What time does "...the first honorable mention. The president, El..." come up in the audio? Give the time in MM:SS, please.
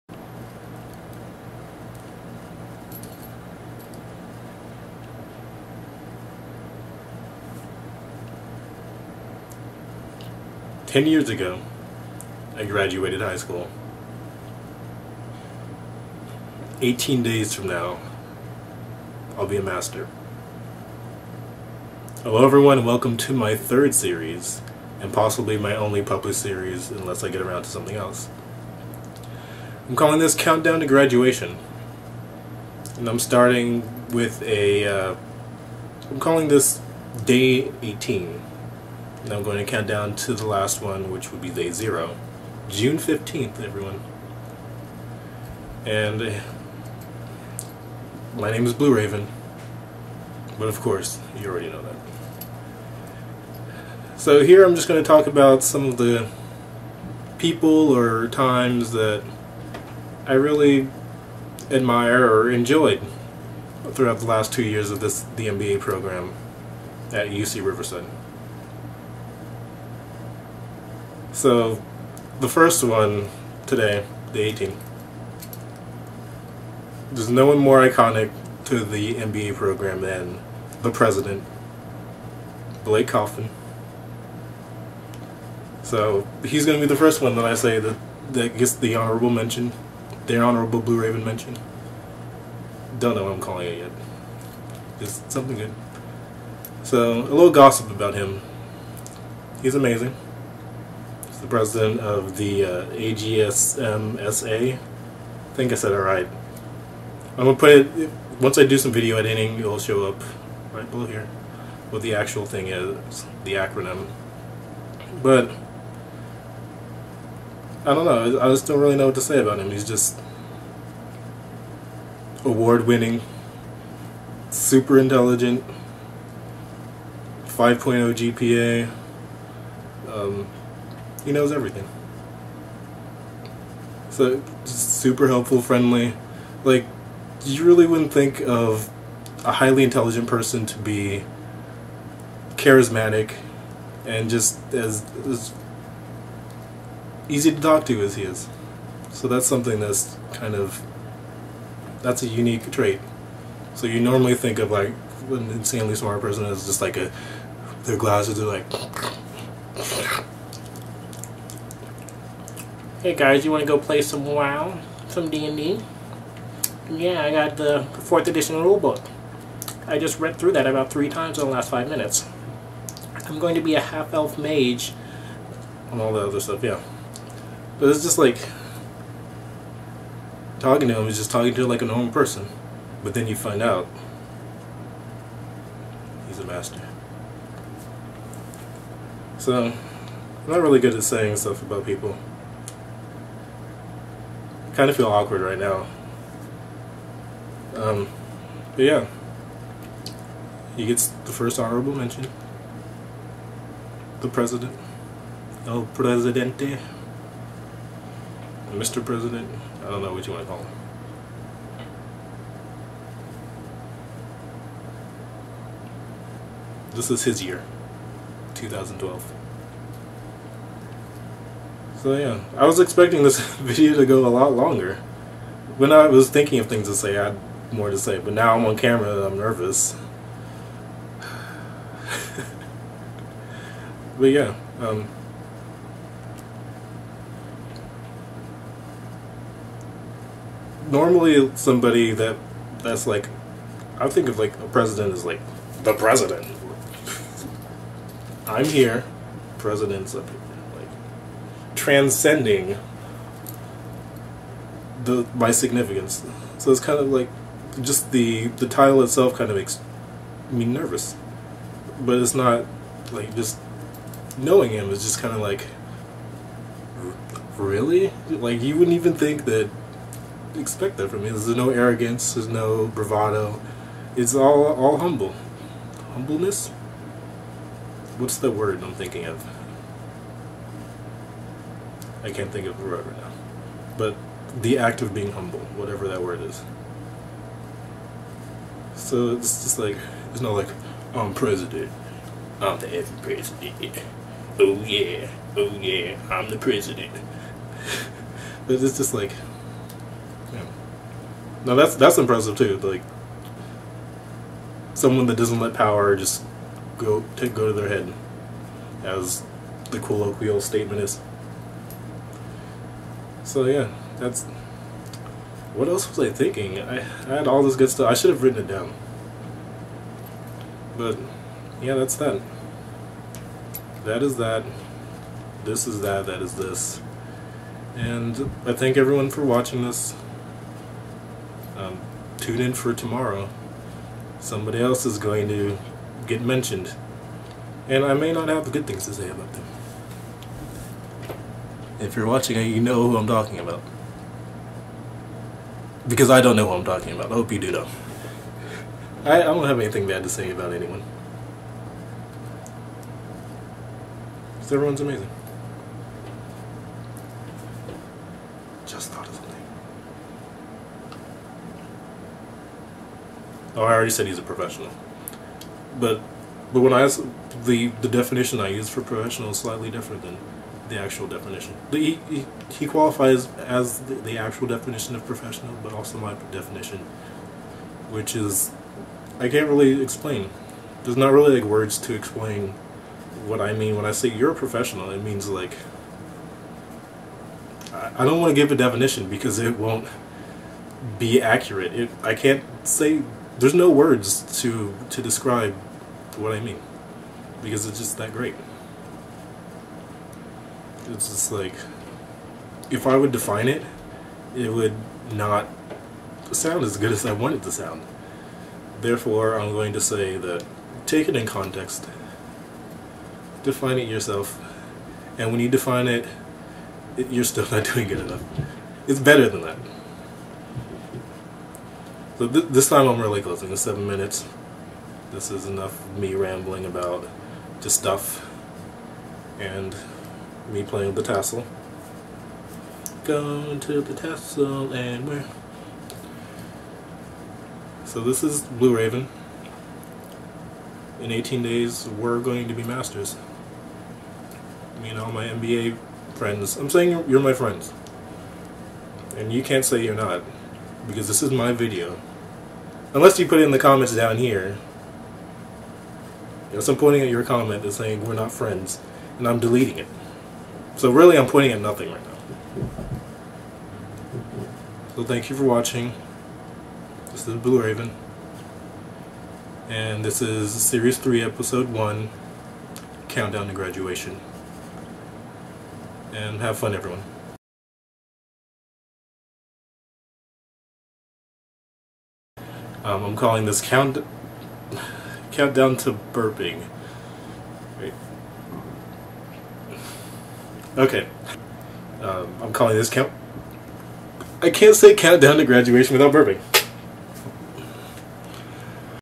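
03:21.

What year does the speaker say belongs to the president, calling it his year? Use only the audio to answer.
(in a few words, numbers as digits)
2012.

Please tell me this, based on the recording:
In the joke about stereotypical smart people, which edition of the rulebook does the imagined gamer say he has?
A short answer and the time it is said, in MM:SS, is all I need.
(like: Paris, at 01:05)
4th edition, at 02:47.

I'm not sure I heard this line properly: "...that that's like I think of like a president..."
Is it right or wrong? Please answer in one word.
right.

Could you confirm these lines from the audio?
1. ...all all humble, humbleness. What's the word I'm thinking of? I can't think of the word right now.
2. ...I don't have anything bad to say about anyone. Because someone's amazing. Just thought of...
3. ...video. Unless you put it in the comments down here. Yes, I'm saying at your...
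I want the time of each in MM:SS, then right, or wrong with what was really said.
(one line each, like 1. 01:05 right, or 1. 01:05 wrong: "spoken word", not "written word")
1. 04:34 right
2. 05:49 wrong: "everyone", not "someone"
3. 07:31 wrong: "pointing", not "saying".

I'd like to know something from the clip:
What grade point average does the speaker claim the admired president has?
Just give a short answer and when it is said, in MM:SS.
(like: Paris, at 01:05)
5.0, at 02:07.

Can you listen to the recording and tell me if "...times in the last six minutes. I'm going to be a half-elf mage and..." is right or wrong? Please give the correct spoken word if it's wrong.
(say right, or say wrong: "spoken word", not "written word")
wrong: "five", not "six".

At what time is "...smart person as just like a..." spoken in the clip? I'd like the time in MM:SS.
02:35.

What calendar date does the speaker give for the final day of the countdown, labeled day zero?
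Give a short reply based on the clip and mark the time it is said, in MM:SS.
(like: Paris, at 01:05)
June 15th, at 00:42.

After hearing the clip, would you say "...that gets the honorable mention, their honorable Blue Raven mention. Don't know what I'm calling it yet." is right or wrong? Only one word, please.
right.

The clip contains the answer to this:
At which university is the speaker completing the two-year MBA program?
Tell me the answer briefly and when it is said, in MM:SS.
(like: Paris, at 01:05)
UC Riverside, at 01:07.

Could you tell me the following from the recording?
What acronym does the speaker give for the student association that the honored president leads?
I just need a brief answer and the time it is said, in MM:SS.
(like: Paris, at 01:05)
AGSMSA, at 01:42.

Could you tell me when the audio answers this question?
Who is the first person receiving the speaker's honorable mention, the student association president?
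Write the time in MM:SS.
01:22.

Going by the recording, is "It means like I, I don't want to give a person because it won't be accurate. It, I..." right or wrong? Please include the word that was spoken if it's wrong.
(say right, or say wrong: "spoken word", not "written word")
wrong: "definition", not "person".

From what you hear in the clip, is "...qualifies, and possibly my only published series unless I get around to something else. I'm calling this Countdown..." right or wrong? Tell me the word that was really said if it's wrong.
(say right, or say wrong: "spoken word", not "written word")
wrong: "series", not "qualifies".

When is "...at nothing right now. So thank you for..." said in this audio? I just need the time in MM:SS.
07:41.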